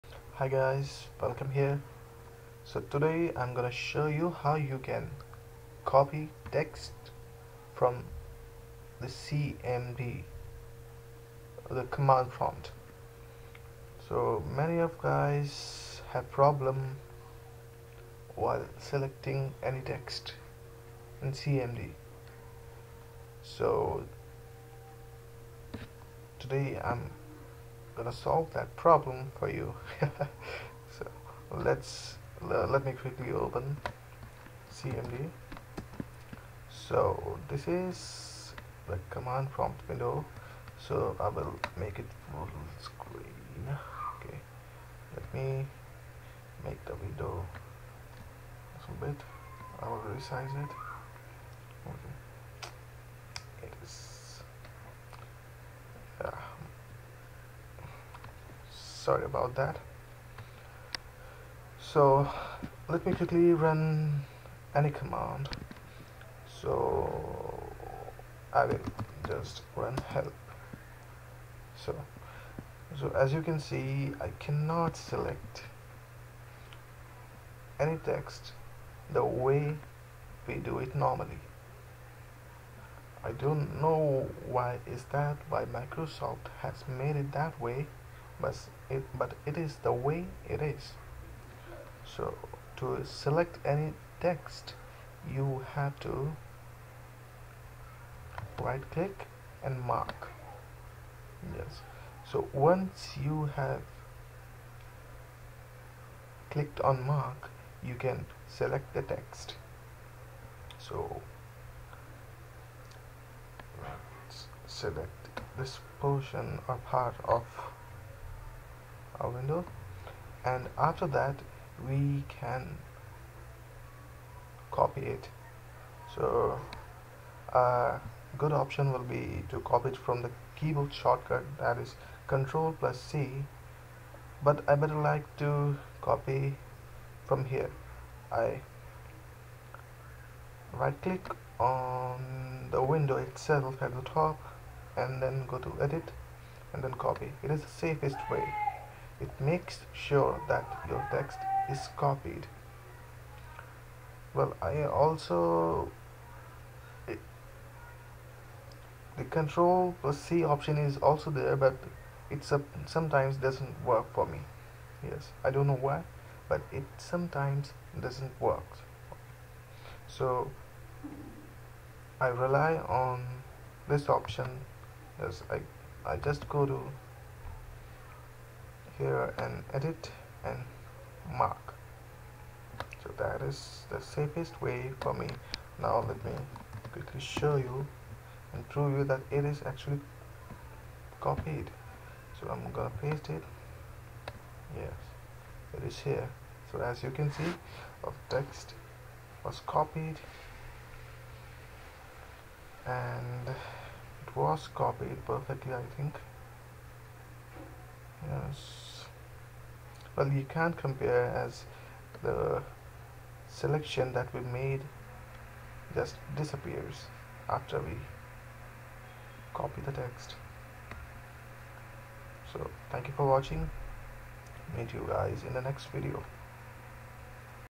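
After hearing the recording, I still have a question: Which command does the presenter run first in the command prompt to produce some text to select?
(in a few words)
help.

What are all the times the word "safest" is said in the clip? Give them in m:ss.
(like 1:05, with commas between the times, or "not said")
2:27, 3:04.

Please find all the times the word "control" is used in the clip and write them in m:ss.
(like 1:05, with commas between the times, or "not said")
2:12, 2:39.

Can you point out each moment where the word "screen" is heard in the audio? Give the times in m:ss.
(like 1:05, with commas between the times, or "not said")
0:42.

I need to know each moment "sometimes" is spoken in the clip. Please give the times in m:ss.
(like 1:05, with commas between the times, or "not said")
2:42, 2:46.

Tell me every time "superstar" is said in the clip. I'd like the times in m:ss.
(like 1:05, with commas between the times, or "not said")
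not said.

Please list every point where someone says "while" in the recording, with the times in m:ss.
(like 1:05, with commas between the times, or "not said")
0:18.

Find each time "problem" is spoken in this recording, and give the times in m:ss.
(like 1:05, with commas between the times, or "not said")
0:16, 0:28.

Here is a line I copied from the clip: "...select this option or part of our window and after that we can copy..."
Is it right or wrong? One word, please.
wrong.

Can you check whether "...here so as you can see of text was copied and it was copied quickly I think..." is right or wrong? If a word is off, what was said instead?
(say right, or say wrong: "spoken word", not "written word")
wrong: "perfectly", not "quickly".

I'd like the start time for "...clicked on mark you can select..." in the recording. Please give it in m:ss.
1:46.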